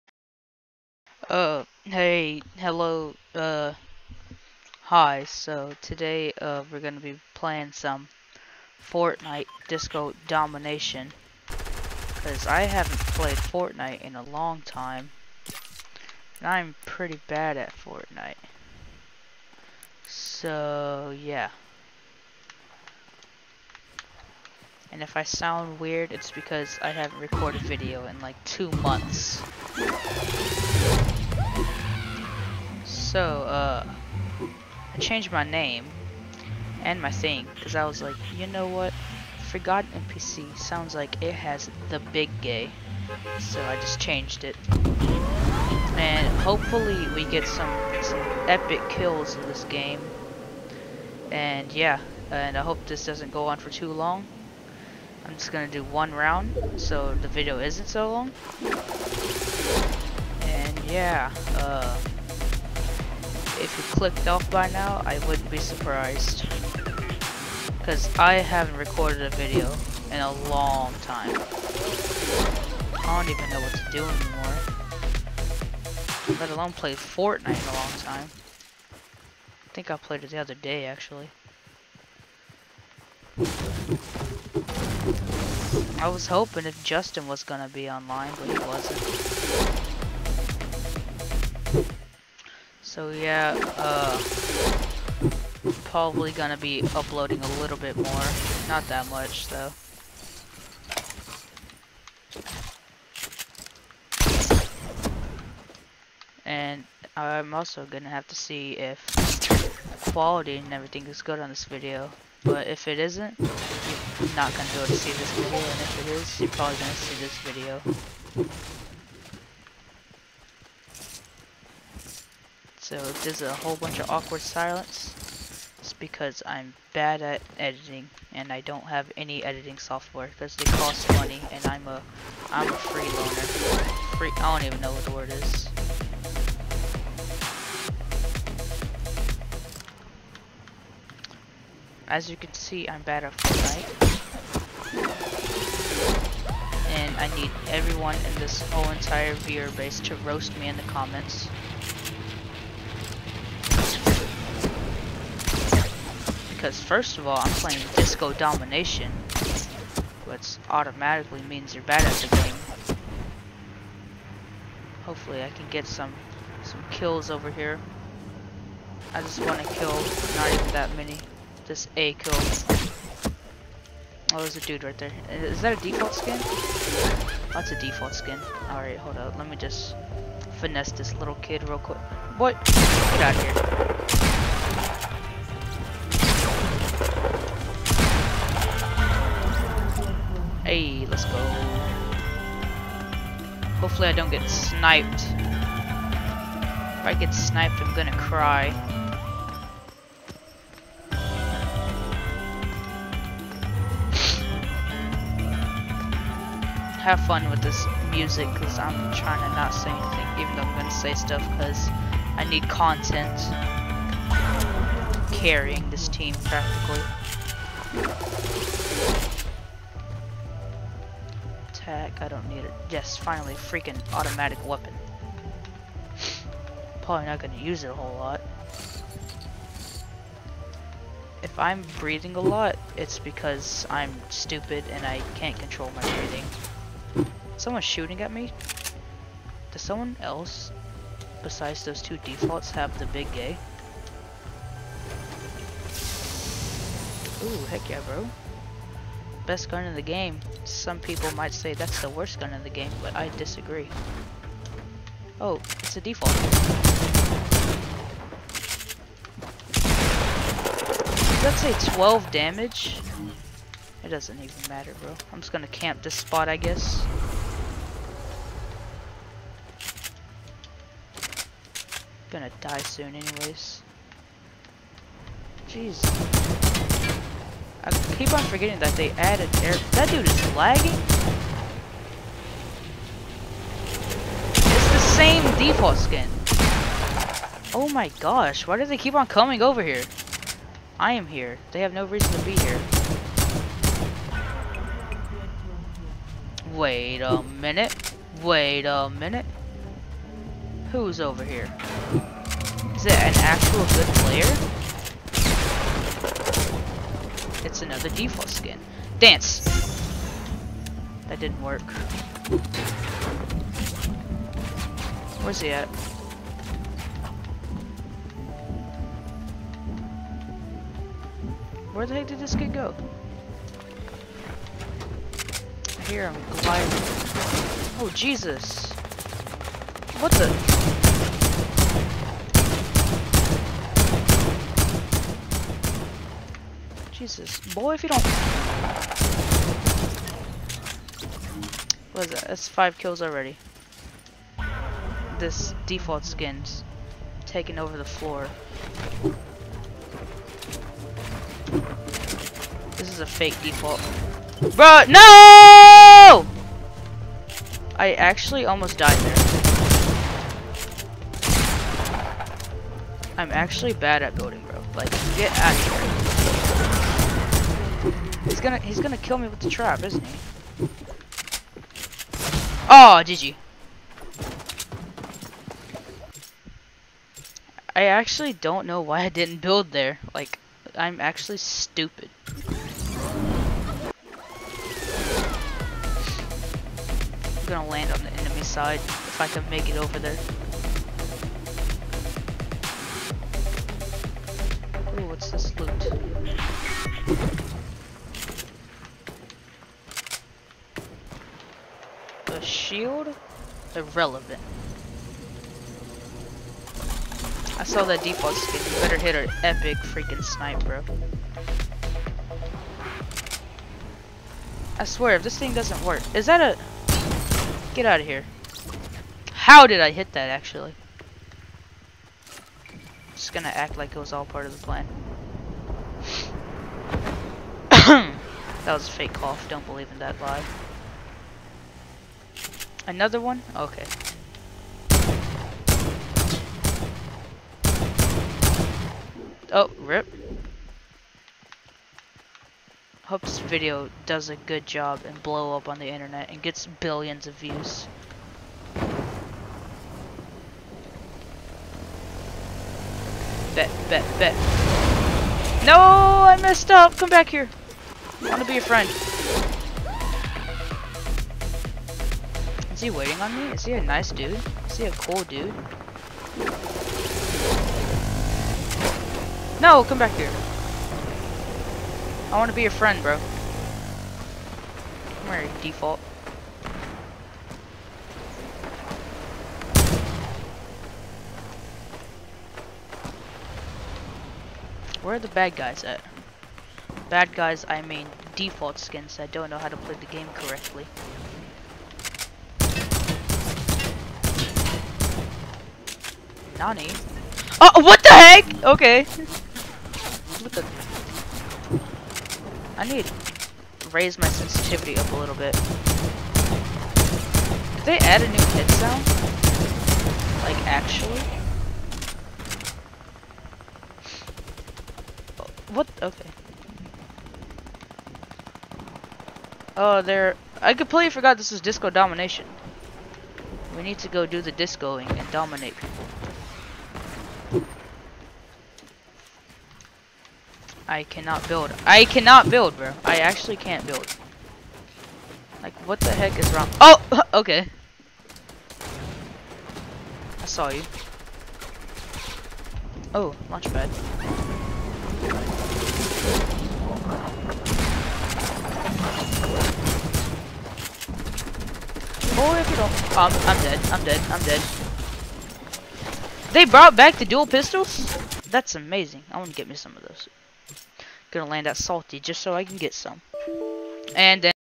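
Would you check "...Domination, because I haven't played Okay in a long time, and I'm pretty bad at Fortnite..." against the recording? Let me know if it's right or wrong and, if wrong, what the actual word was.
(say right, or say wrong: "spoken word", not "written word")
wrong: "Fortnite", not "Okay".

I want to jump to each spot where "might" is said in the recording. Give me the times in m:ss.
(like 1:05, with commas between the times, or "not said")
4:11.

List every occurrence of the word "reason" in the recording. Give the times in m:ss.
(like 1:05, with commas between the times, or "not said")
4:52.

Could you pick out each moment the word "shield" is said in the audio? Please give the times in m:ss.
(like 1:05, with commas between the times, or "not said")
6:42.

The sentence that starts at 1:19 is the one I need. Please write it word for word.
I think I played it the other day, actually.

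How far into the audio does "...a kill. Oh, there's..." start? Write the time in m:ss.
2:51.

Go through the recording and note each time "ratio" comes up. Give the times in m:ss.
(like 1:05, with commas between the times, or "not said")
not said.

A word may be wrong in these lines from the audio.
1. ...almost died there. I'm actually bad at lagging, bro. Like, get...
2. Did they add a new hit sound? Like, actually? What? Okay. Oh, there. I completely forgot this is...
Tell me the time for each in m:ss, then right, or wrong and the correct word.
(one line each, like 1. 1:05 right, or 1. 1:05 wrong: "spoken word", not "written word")
1. 5:58 wrong: "building", not "lagging"
2. 8:27 right.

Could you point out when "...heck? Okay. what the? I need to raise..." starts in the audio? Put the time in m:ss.
8:18.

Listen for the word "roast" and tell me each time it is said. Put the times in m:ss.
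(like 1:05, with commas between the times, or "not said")
2:30.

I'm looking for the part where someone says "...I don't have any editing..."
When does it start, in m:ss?
2:08.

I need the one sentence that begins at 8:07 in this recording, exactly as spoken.
Bad guys, I mean default skins that don't know how to play the game correctly.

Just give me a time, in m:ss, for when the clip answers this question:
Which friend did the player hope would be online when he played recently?
1:26.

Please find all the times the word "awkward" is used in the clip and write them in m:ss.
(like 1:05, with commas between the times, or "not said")
2:04.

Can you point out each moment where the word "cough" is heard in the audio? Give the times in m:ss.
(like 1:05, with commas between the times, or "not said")
7:09.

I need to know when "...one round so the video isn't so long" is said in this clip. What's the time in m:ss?
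0:55.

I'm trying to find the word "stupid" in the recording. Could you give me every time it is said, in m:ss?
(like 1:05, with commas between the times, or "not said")
3:54, 6:21.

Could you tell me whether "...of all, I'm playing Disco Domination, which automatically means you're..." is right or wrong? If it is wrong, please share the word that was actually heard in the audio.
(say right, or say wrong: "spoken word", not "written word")
right.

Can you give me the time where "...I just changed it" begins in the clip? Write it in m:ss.
0:43.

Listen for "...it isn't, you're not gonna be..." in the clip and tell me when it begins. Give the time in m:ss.
1:52.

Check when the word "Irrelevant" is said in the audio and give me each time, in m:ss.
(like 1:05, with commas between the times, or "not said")
6:43.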